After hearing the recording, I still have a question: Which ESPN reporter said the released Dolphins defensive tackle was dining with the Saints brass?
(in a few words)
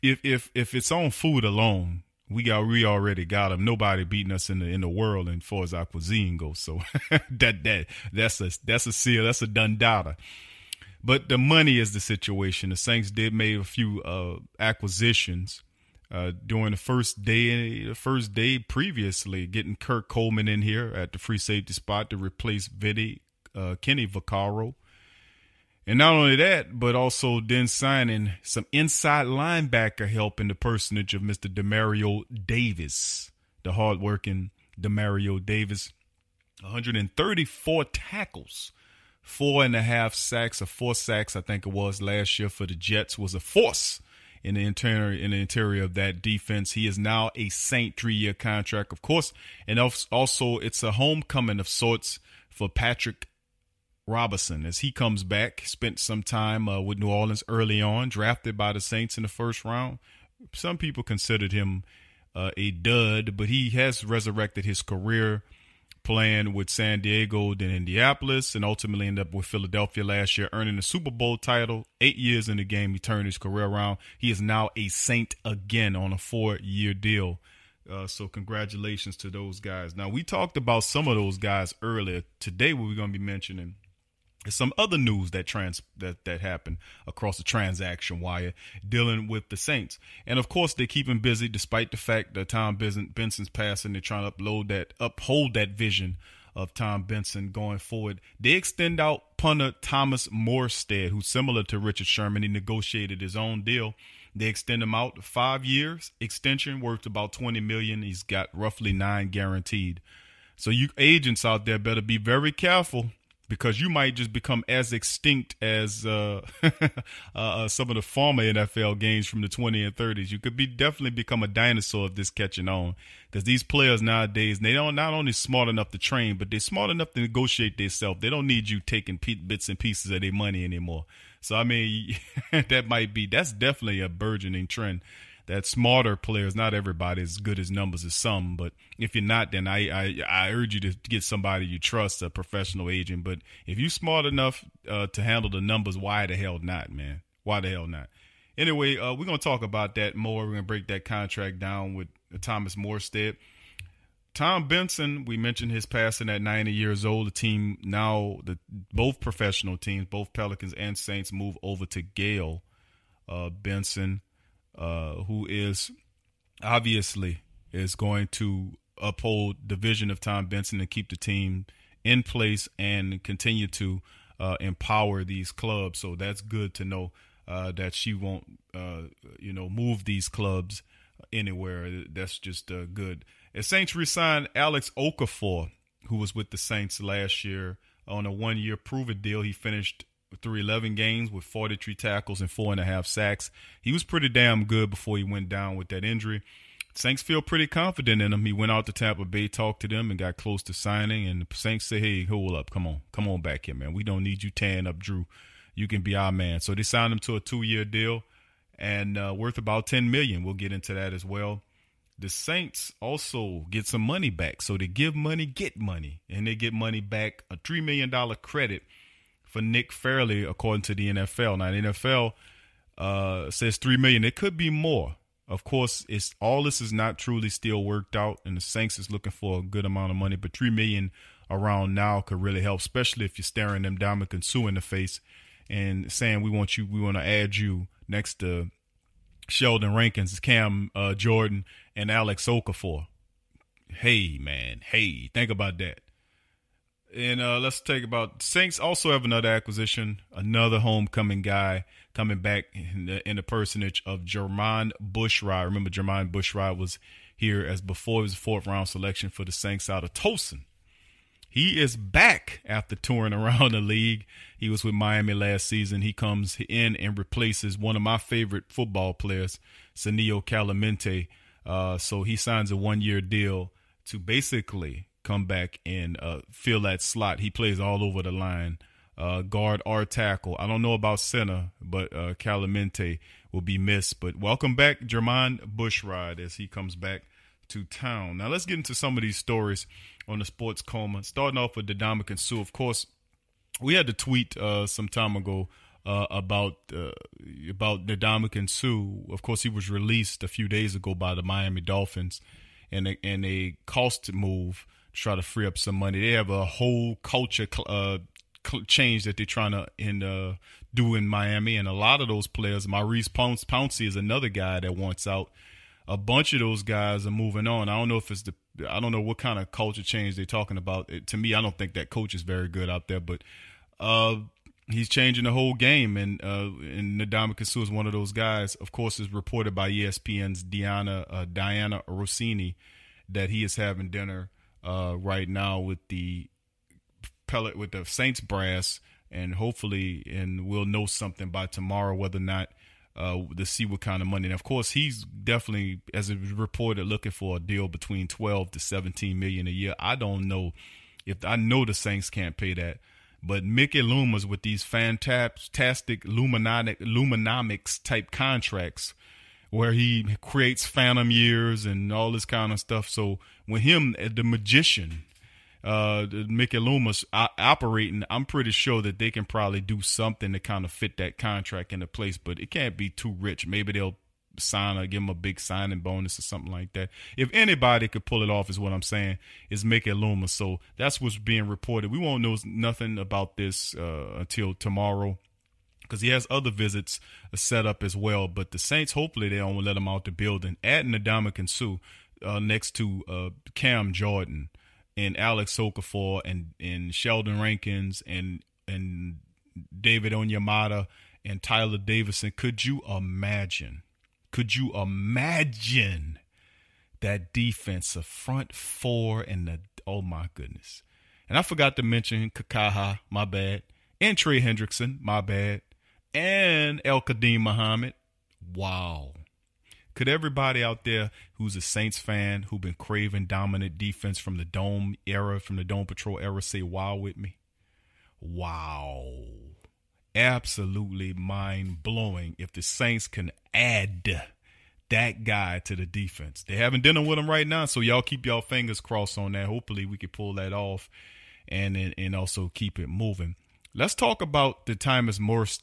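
Diana Russini.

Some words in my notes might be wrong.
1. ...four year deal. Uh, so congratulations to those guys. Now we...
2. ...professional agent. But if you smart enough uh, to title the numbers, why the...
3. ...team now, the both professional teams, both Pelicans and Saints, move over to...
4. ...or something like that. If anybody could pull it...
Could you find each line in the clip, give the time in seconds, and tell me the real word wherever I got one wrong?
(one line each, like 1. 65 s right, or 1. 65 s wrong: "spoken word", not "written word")
1. 76 s right
2. 142 s wrong: "handle", not "title"
3. 157 s right
4. 376 s right.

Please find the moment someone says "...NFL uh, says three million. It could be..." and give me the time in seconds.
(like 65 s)
221 s.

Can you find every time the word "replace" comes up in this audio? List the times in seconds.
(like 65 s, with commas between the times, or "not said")
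22 s, 267 s.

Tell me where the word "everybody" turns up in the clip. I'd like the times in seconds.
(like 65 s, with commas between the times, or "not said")
136 s, 420 s.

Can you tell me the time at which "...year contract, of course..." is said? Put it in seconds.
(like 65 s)
48 s.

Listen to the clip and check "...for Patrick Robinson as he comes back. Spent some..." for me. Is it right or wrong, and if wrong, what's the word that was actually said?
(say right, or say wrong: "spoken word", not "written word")
right.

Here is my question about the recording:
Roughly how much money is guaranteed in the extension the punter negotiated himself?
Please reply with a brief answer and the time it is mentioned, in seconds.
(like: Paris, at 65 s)
9 million, at 108 s.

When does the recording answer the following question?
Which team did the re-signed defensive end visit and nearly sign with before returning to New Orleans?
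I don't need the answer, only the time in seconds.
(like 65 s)
198 s.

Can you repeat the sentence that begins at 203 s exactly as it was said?
We don't need you tanning up, Drew.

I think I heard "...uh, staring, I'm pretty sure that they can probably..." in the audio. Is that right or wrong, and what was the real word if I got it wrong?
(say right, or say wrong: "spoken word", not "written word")
wrong: "operating", not "staring".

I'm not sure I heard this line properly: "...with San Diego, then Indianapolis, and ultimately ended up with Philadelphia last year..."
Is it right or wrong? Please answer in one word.
right.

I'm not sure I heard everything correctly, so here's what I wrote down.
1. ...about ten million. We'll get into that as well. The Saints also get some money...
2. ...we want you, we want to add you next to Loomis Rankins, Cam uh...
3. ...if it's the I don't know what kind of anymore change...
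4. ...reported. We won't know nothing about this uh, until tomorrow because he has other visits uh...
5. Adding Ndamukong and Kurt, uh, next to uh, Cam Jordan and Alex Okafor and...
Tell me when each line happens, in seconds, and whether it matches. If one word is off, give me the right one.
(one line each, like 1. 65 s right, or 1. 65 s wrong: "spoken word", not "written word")
1. 209 s right
2. 236 s wrong: "Sheldon", not "Loomis"
3. 318 s wrong: "culture", not "anymore"
4. 381 s right
5. 390 s wrong: "Suh", not "Kurt".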